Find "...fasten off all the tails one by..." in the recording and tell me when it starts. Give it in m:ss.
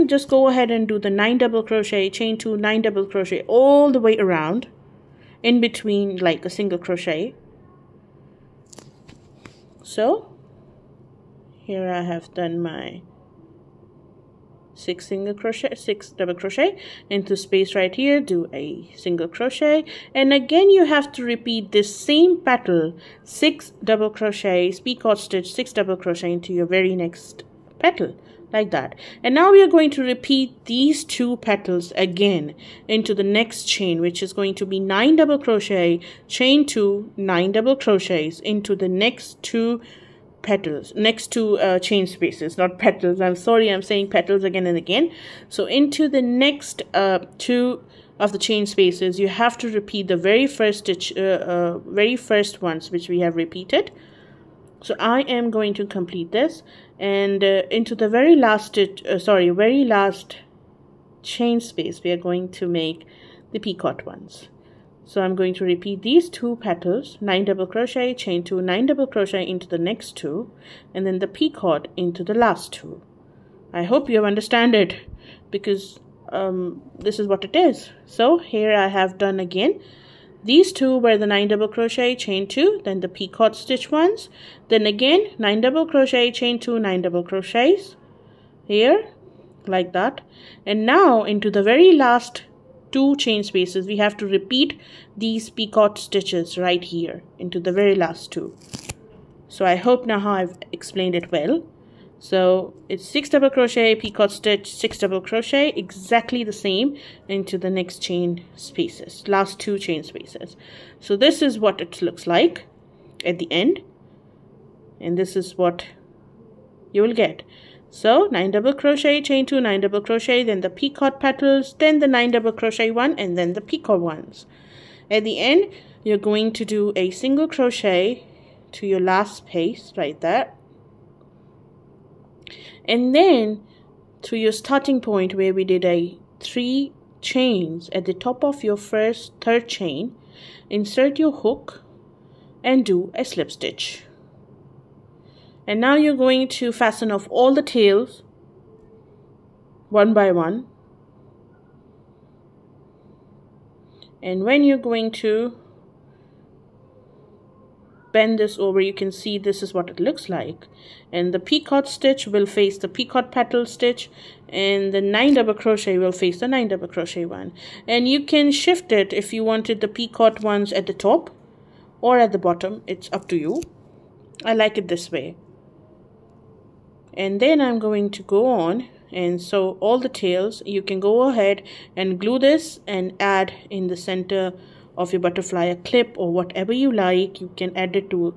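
2:26.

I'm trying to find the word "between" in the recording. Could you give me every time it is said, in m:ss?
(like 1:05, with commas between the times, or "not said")
0:05.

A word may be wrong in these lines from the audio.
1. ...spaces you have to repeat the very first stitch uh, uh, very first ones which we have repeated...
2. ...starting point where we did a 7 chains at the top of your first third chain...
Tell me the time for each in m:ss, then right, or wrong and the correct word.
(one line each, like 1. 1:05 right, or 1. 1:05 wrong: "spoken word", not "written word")
1. 0:48 right
2. 2:14 wrong: "3", not "7".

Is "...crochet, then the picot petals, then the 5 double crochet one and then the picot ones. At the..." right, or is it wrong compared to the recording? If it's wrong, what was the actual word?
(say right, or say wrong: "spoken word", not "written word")
wrong: "9", not "5".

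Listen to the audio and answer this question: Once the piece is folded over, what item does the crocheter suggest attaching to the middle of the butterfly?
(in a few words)
A clip.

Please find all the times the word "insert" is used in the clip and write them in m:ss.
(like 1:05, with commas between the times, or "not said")
2:20.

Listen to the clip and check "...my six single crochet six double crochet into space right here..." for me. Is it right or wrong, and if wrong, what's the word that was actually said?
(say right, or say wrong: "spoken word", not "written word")
right.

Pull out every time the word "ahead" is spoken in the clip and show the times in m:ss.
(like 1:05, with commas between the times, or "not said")
0:00, 3:01.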